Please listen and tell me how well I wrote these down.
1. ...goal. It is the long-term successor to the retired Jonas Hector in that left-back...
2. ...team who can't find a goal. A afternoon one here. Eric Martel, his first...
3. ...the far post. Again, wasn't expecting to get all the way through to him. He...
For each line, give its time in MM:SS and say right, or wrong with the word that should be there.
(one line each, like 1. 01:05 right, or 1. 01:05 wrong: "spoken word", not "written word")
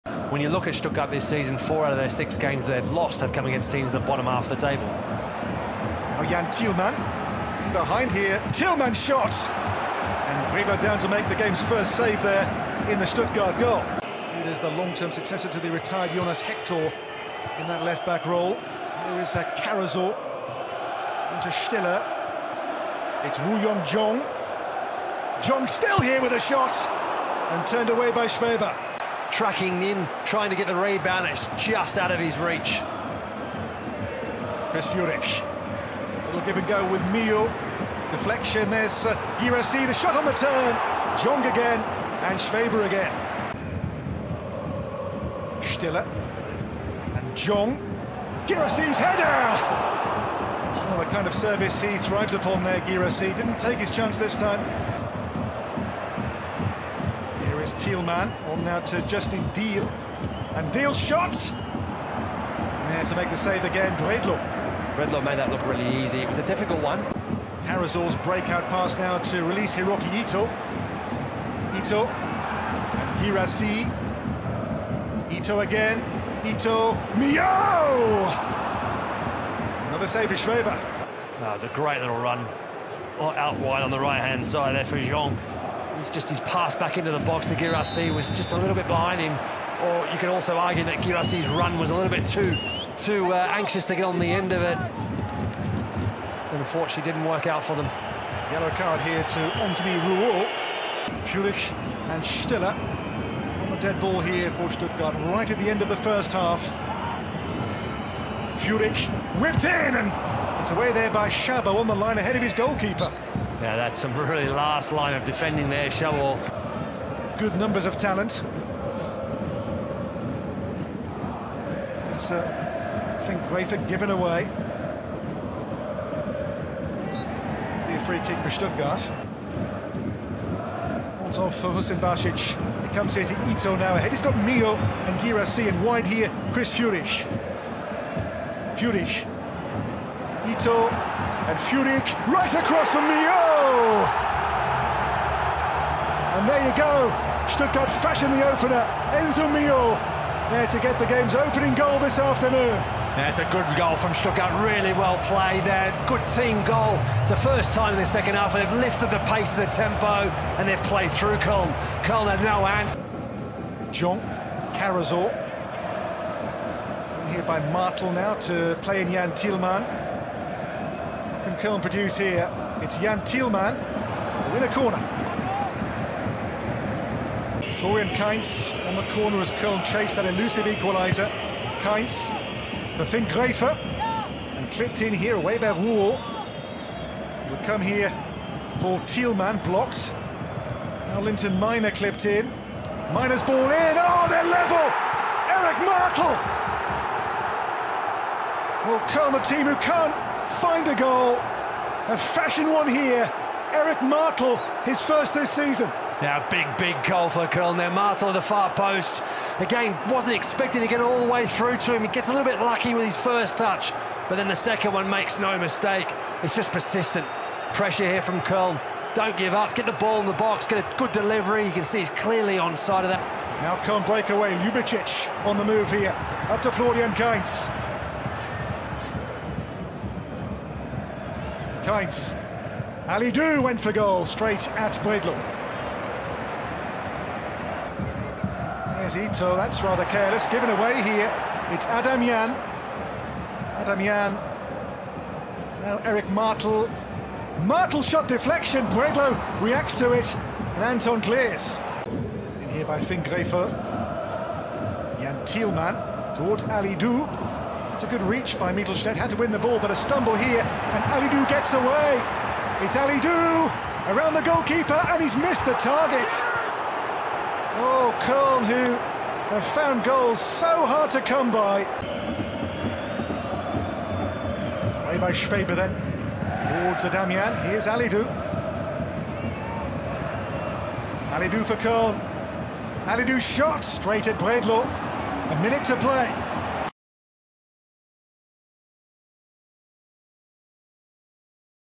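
1. 00:13 right
2. 03:19 wrong: "fashion", not "afternoon"
3. 03:28 right.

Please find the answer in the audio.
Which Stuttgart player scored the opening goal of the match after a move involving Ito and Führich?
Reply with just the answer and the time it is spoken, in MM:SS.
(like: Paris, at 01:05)
Enzo Millot, at 02:29.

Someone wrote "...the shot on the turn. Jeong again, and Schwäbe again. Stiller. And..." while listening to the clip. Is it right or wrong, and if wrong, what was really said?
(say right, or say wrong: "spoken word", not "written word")
right.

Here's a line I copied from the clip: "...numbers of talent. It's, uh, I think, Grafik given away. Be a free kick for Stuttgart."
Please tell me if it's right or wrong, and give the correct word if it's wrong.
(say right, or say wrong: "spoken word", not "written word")
right.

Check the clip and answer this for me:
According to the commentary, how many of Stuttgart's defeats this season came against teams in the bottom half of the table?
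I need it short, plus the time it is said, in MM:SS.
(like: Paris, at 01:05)
4, at 00:01.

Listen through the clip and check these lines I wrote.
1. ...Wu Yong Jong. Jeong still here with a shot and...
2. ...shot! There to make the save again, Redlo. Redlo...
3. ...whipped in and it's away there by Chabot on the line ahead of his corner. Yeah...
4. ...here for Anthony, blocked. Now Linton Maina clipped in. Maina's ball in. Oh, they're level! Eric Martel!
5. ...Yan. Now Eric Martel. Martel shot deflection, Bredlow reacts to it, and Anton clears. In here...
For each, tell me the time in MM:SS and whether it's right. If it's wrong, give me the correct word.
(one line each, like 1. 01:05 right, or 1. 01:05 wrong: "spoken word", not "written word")
1. 00:23 right
2. 01:00 right
3. 01:49 wrong: "goalkeeper", not "corner"
4. 03:07 wrong: "Thielmann", not "Anthony"
5. 04:03 right.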